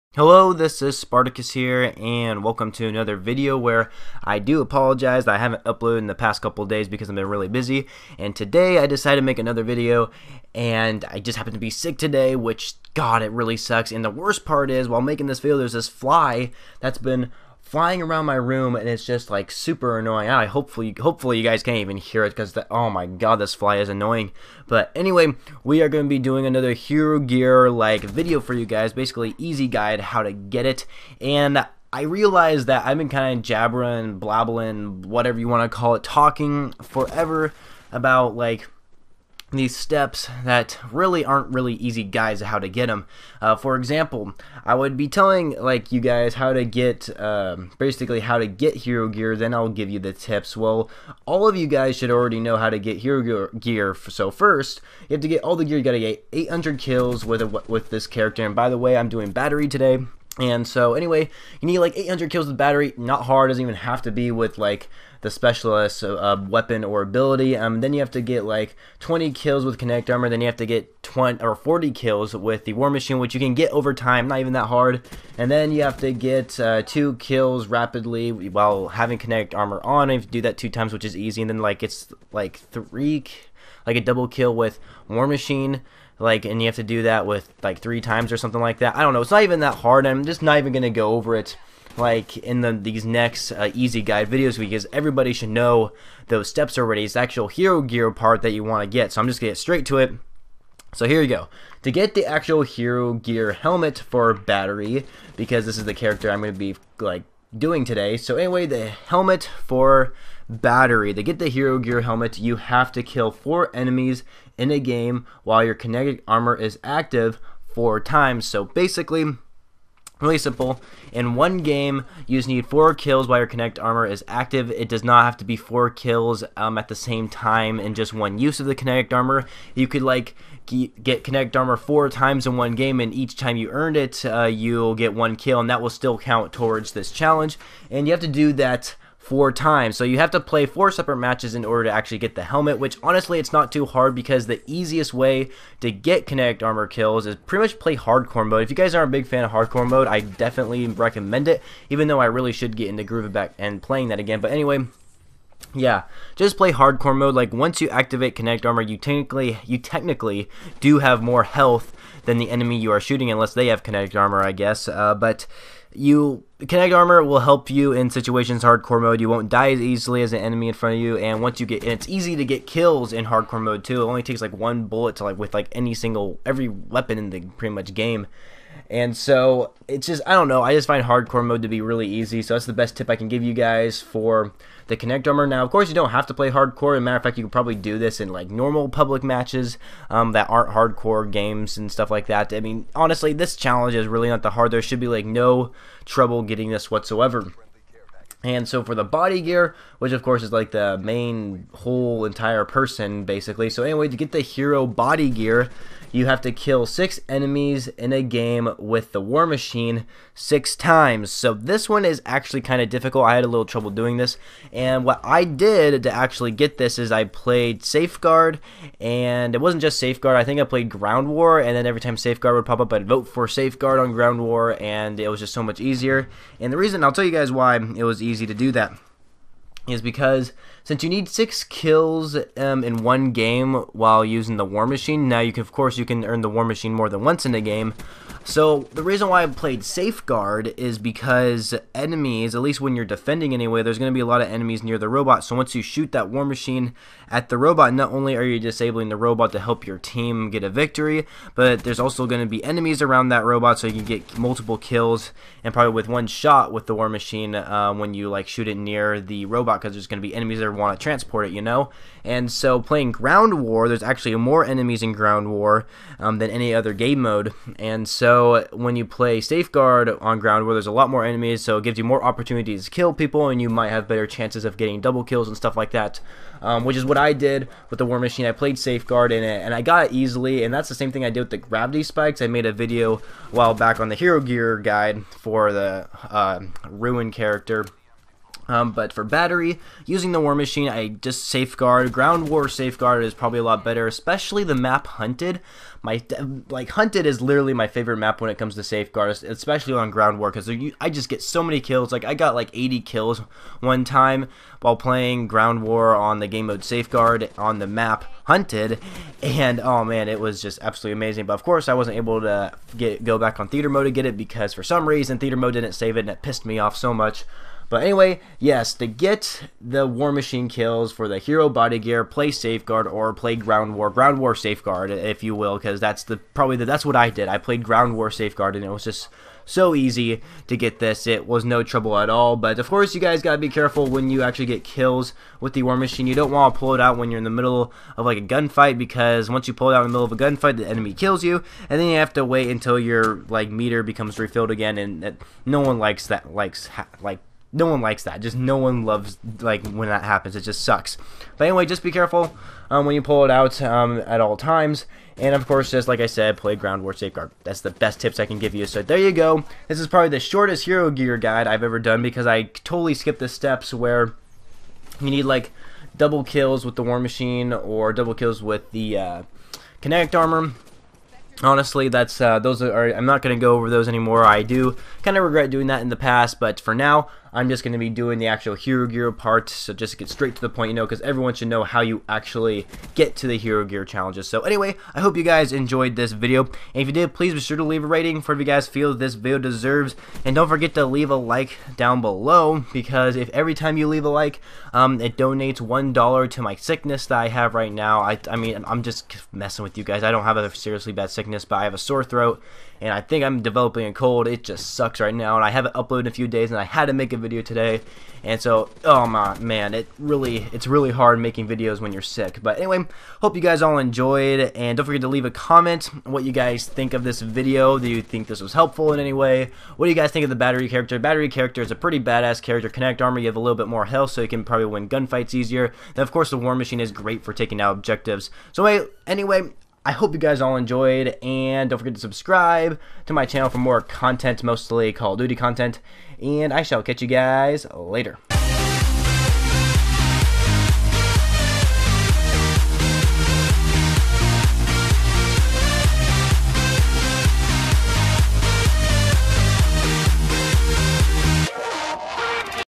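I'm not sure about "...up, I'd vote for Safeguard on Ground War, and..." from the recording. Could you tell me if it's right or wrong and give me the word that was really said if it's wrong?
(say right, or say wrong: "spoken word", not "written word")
right.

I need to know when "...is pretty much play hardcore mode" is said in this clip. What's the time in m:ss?
2:27.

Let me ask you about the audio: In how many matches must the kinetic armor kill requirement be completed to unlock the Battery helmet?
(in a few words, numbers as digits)
4.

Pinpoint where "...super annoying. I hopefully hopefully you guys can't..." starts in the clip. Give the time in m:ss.
0:19.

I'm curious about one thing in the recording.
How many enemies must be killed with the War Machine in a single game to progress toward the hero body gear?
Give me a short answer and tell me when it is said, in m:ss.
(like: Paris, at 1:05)
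6, at 3:26.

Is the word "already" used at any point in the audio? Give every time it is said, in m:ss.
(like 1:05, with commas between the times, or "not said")
0:52, 1:36.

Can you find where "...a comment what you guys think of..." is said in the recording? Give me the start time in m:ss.
6:55.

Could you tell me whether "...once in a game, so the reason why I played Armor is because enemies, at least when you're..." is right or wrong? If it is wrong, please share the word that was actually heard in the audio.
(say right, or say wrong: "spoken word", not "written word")
wrong: "Safeguard", not "Armor".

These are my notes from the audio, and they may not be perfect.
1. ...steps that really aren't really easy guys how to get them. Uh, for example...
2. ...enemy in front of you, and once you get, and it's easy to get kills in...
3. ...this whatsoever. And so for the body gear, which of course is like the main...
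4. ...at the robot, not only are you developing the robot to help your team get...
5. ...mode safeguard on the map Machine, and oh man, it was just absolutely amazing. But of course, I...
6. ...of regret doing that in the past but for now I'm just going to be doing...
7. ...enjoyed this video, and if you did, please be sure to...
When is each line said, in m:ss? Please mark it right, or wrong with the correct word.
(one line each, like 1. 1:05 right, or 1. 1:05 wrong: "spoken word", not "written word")
1. 0:39 right
2. 2:50 right
3. 3:16 right
4. 4:07 wrong: "disabling", not "developing"
5. 5:06 wrong: "Hunted", not "Machine"
6. 6:15 right
7. 6:25 right.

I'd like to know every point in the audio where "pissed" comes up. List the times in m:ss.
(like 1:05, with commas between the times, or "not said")
5:16.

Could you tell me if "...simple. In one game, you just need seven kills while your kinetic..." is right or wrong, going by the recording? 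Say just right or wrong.
wrong.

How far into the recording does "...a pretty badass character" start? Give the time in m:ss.
7:01.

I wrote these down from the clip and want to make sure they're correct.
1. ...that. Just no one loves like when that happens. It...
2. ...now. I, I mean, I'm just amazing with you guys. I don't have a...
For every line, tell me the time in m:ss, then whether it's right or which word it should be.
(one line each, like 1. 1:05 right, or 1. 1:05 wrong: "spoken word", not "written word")
1. 5:48 right
2. 6:37 wrong: "messing", not "amazing".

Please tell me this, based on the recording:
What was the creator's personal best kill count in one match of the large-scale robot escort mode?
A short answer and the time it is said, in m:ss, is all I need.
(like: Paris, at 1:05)
80, at 5:02.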